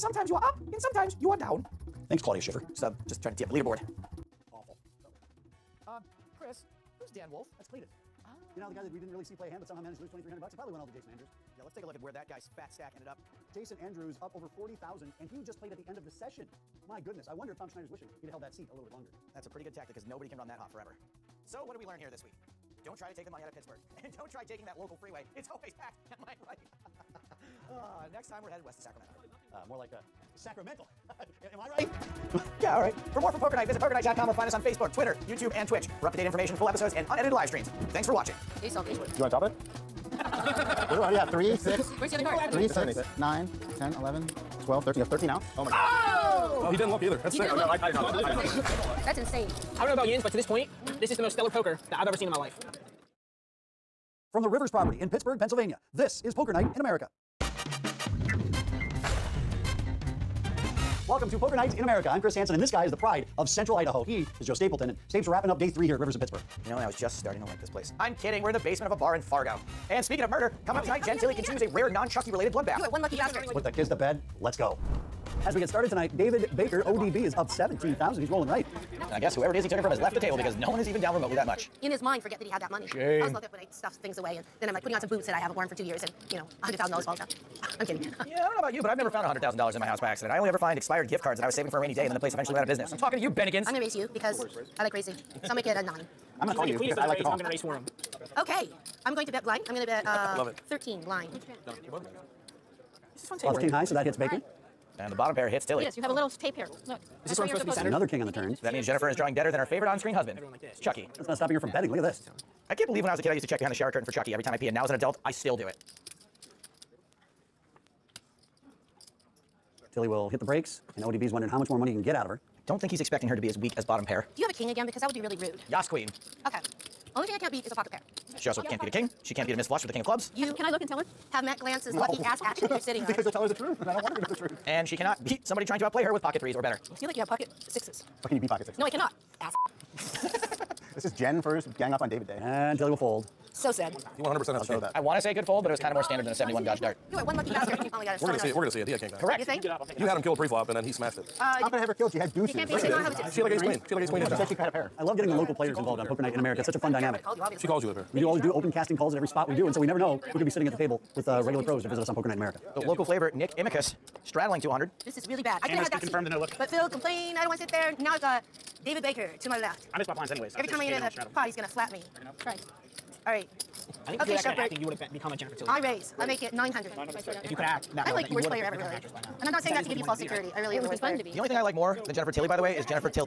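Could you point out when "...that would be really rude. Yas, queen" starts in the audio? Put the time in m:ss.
2:05.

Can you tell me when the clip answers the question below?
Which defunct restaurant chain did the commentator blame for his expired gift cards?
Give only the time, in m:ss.
1:33.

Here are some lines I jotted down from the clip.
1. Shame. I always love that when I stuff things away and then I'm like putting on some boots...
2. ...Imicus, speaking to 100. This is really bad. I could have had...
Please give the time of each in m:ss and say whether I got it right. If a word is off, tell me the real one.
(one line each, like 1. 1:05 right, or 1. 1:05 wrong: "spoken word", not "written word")
1. 1:22 right
2. 2:43 wrong: "straddling", not "speaking".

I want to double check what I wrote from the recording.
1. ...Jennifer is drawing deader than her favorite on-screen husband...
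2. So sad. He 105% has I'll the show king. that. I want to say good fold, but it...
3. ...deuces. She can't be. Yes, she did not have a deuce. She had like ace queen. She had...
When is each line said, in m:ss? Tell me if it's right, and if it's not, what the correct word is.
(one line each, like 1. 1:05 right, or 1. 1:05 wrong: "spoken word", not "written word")
1. 1:48 right
2. 2:23 wrong: "100", not "105"
3. 2:32 right.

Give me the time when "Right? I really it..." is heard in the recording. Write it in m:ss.
3:00.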